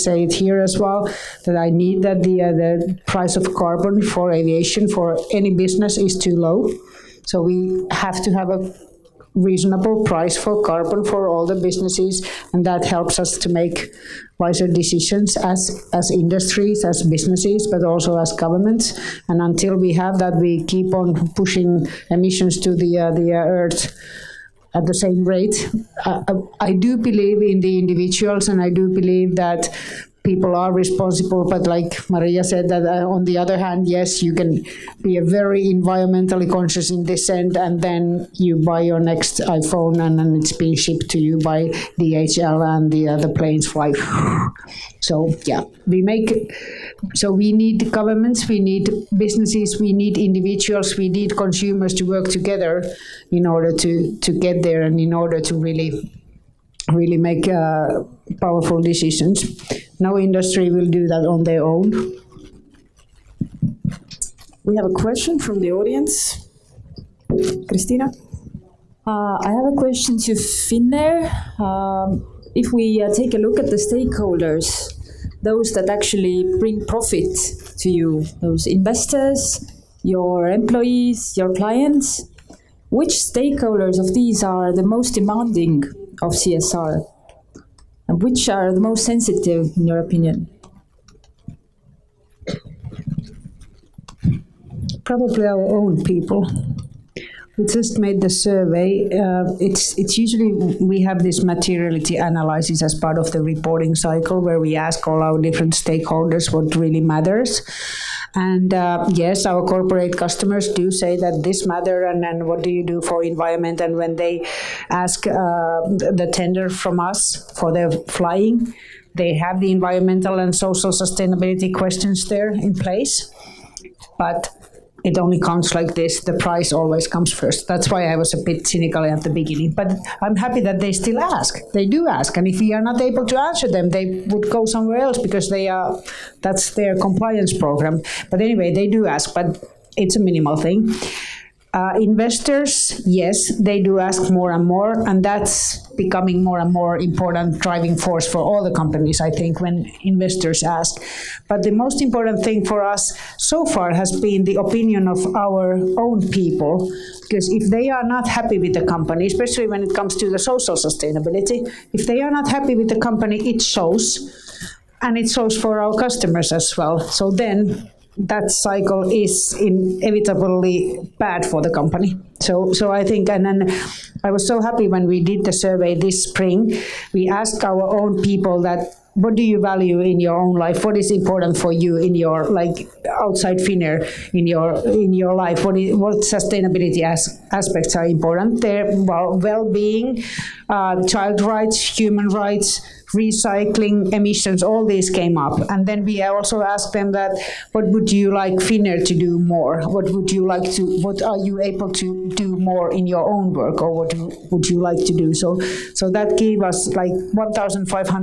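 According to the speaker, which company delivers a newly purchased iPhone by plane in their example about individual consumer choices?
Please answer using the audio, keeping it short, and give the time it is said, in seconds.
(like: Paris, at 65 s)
DHL, at 41 s.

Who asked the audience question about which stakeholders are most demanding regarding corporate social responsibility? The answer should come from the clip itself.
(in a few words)
Christina.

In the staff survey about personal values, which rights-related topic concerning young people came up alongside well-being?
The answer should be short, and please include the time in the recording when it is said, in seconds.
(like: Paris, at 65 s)
Child rights, at 191 s.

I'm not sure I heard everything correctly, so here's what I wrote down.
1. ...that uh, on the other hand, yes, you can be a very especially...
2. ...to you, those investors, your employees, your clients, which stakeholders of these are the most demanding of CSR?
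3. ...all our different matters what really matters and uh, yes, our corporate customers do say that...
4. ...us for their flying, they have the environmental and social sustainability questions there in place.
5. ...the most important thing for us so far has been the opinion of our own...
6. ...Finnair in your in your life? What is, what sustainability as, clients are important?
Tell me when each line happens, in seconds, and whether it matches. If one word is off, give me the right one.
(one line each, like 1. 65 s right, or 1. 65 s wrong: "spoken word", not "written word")
1. 32 s wrong: "environmentally", not "especially"
2. 77 s right
3. 105 s wrong: "stakeholders", not "matters"
4. 116 s right
5. 151 s right
6. 183 s wrong: "aspects", not "clients".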